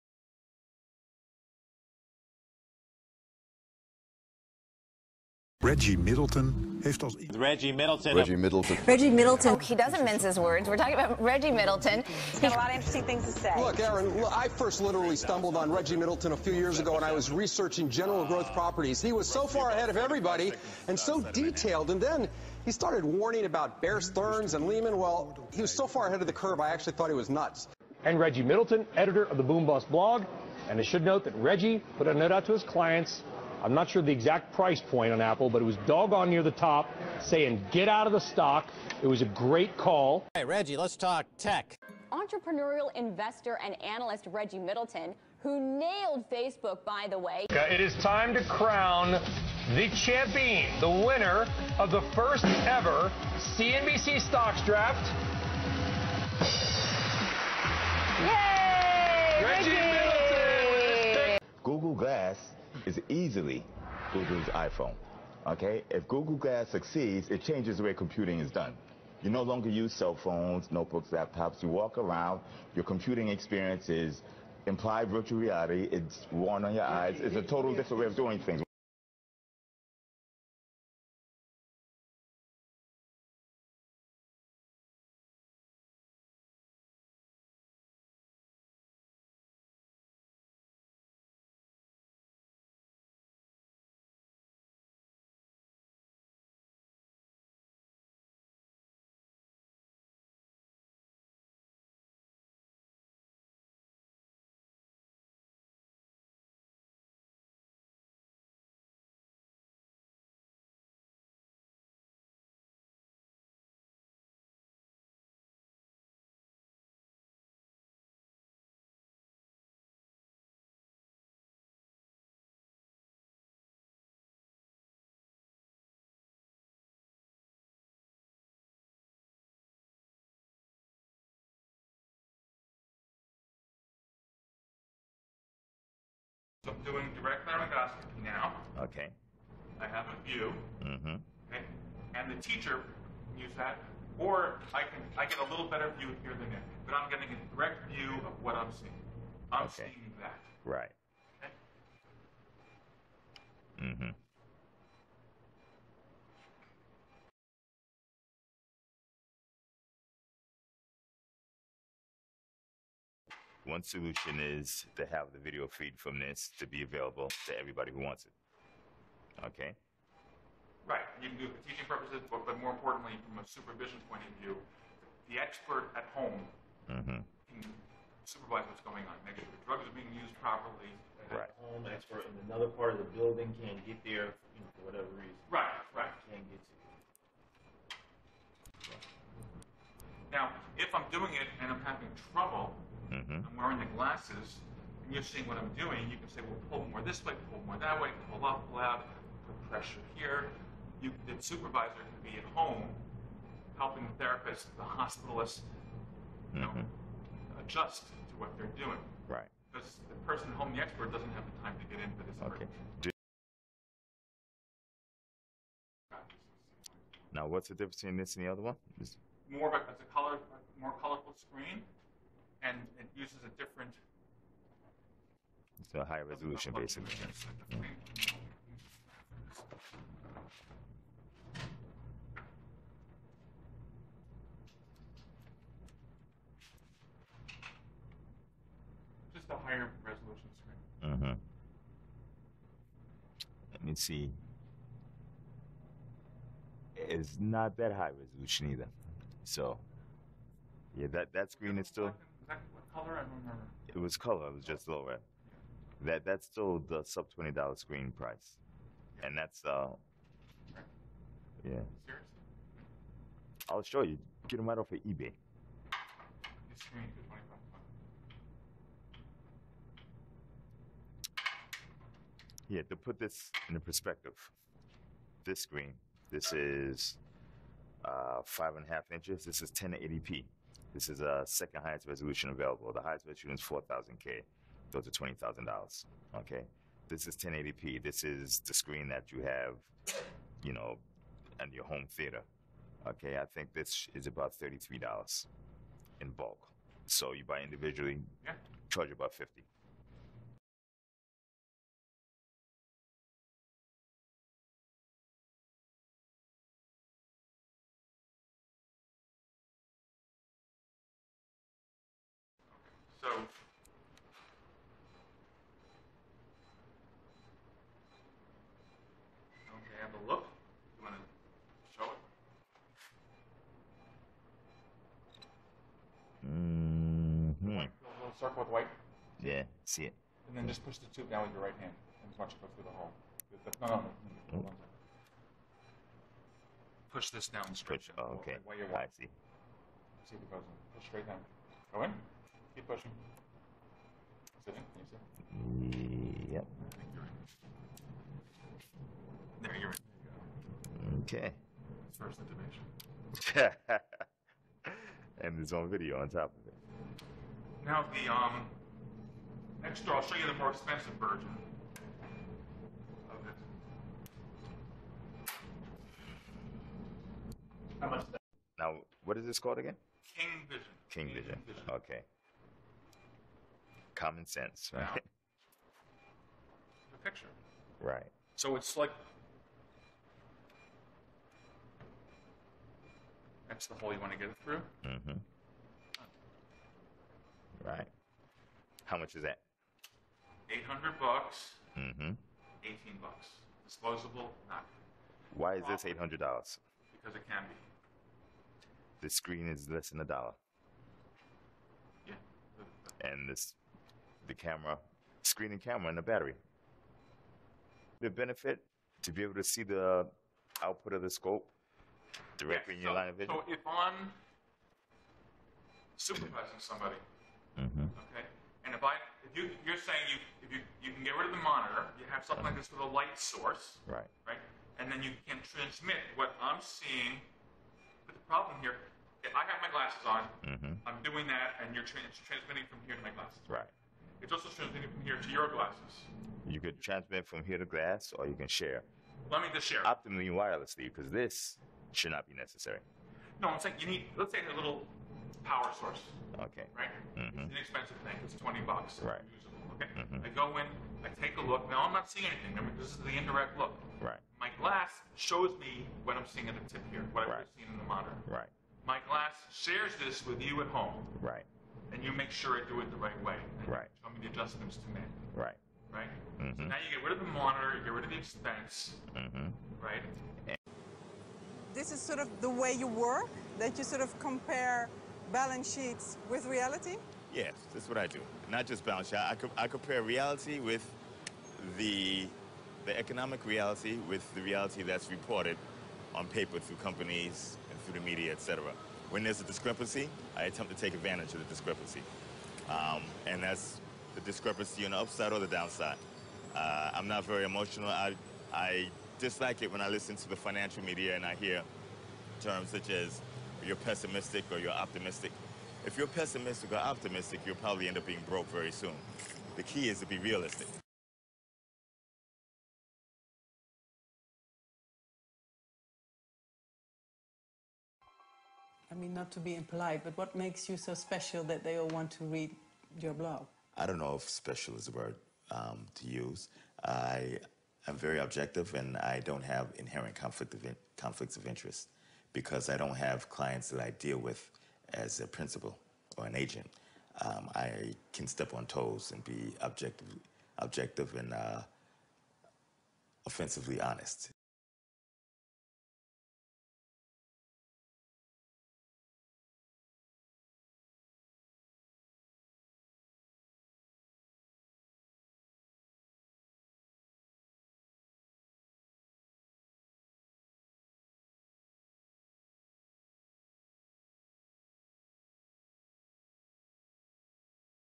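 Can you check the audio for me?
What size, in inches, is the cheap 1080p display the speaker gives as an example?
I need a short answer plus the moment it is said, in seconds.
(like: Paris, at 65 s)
5.5 inches, at 278 s.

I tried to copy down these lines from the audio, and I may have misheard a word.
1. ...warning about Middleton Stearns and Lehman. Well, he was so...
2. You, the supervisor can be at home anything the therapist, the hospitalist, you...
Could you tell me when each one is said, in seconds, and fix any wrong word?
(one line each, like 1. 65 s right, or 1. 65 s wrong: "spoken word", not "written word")
1. 23 s wrong: "Bear", not "Middleton"
2. 201 s wrong: "helping", not "anything".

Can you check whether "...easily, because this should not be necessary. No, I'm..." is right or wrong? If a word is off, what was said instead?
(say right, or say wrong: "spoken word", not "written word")
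wrong: "wirelessly", not "easily".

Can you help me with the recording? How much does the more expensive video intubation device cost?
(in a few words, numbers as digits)
$800.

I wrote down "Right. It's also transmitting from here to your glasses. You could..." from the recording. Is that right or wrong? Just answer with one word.
right.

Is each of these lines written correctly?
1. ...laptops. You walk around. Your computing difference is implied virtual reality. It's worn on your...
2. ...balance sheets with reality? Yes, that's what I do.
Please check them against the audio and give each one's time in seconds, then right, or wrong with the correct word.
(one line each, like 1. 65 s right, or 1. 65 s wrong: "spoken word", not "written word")
1. 71 s wrong: "experience", not "difference"
2. 475 s right.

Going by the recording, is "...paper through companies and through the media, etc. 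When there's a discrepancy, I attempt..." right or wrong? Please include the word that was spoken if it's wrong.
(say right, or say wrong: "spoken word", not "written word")
right.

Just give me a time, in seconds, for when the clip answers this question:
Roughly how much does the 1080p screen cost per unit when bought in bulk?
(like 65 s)
294 s.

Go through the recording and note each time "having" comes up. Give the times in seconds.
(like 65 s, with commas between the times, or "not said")
191 s.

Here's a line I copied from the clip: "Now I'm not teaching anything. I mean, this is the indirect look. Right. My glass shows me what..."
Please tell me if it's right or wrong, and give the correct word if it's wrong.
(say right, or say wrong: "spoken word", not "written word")
wrong: "seeing", not "teaching".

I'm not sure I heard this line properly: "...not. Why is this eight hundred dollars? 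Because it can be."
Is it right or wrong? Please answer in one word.
right.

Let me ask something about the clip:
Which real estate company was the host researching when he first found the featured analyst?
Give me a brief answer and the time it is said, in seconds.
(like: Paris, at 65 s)
General Growth Properties, at 17 s.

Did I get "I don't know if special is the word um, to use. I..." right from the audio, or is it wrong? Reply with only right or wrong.
right.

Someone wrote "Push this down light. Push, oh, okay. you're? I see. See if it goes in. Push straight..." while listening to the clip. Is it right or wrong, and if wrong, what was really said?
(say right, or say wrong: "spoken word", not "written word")
wrong: "straight", not "light".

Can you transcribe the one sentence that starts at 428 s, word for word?
But the problem here, if I have my glasses on.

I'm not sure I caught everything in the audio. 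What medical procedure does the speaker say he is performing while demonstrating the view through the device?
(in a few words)
direct laryngoscopy.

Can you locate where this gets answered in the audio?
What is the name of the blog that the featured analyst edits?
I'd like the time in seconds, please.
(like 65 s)
29 s.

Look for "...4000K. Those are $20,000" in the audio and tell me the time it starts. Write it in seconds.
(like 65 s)
283 s.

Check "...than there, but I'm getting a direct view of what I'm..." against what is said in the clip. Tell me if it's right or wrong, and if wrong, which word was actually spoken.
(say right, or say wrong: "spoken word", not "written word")
right.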